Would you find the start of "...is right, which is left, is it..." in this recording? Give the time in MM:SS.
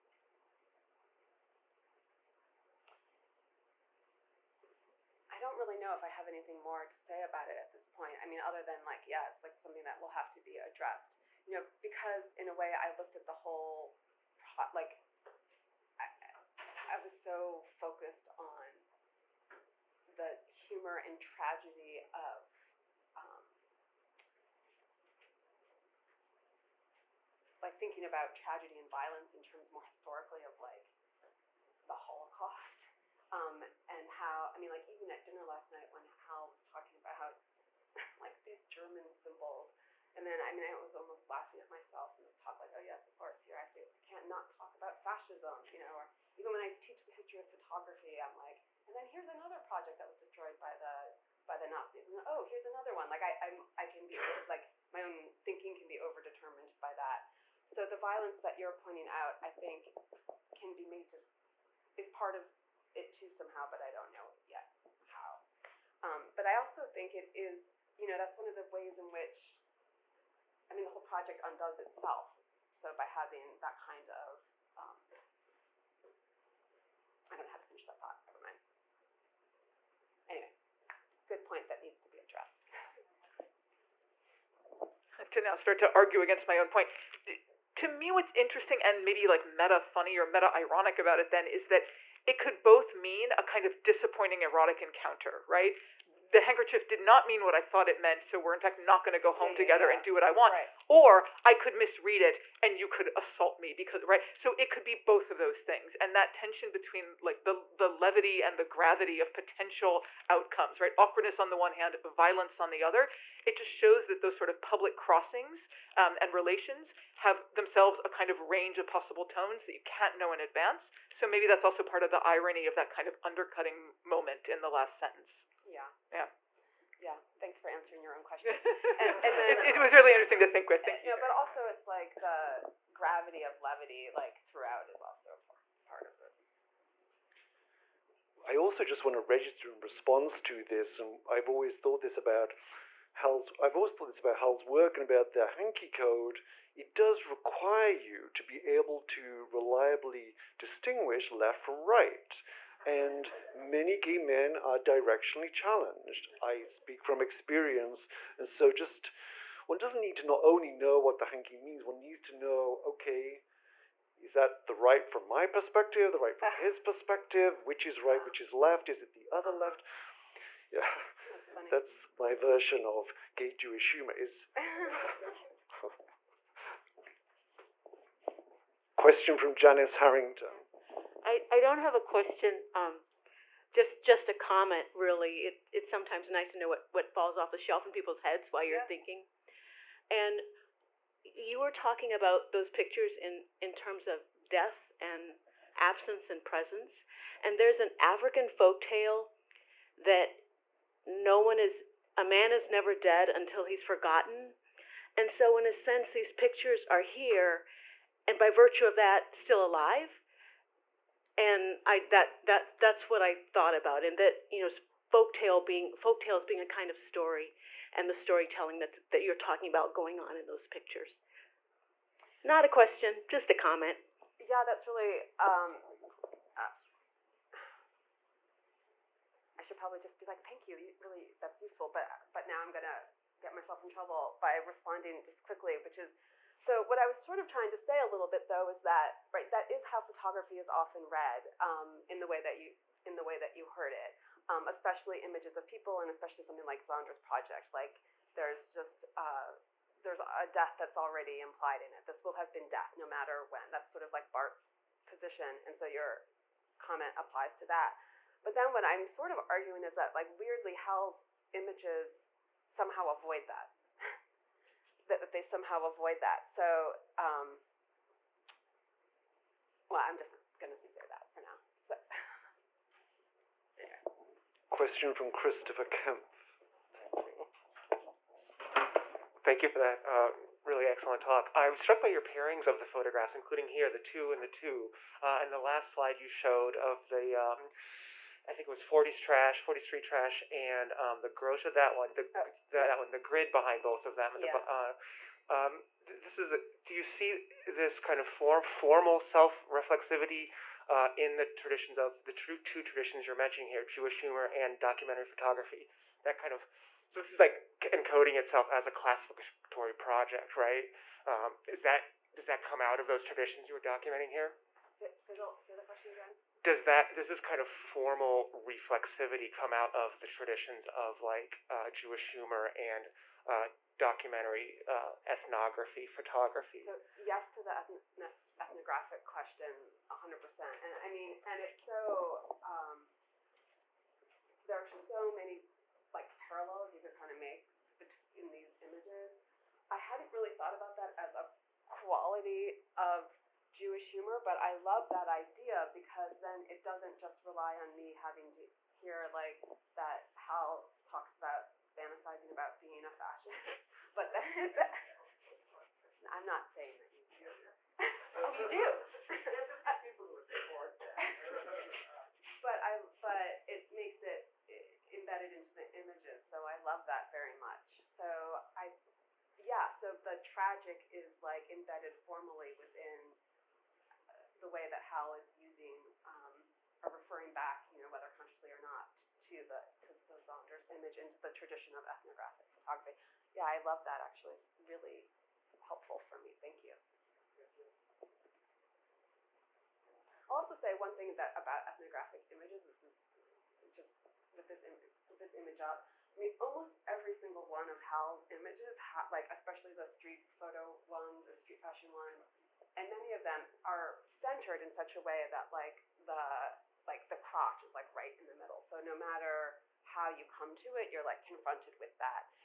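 02:47.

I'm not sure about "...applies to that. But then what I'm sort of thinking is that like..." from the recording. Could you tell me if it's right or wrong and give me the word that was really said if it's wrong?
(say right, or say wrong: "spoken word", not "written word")
wrong: "arguing", not "thinking".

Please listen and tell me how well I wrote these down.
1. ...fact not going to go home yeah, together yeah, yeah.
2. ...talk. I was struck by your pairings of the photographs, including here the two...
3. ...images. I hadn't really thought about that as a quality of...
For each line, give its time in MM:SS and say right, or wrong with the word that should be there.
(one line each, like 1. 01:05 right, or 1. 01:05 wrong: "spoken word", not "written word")
1. 01:38 right
2. 04:41 right
3. 05:38 right.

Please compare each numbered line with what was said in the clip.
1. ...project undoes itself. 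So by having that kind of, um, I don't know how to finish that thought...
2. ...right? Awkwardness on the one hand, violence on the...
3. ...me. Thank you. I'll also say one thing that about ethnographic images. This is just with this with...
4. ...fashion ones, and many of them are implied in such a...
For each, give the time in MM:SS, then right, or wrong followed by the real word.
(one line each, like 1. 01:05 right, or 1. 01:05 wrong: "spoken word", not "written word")
1. 01:11 right
2. 01:50 right
3. 06:26 right
4. 06:41 wrong: "centered", not "implied".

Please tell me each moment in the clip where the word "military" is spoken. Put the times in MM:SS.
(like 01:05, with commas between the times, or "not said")
not said.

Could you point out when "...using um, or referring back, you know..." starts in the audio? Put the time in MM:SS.
06:15.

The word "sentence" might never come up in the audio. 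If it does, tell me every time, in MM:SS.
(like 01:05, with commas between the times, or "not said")
02:04.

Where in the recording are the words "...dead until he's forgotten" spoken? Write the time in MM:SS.
03:22.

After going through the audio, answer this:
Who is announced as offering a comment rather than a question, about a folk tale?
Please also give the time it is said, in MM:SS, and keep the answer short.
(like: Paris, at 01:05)
Janice Harrington, at 02:59.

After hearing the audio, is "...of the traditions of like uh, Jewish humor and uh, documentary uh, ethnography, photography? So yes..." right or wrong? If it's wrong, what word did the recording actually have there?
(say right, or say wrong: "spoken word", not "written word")
right.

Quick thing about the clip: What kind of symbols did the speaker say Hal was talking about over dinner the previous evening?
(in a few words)
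German symbols.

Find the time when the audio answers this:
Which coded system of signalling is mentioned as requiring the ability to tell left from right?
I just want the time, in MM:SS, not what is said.
02:25.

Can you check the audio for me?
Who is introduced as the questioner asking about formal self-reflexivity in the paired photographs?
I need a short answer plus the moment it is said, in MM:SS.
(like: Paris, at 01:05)
Christopher Kemp, at 04:35.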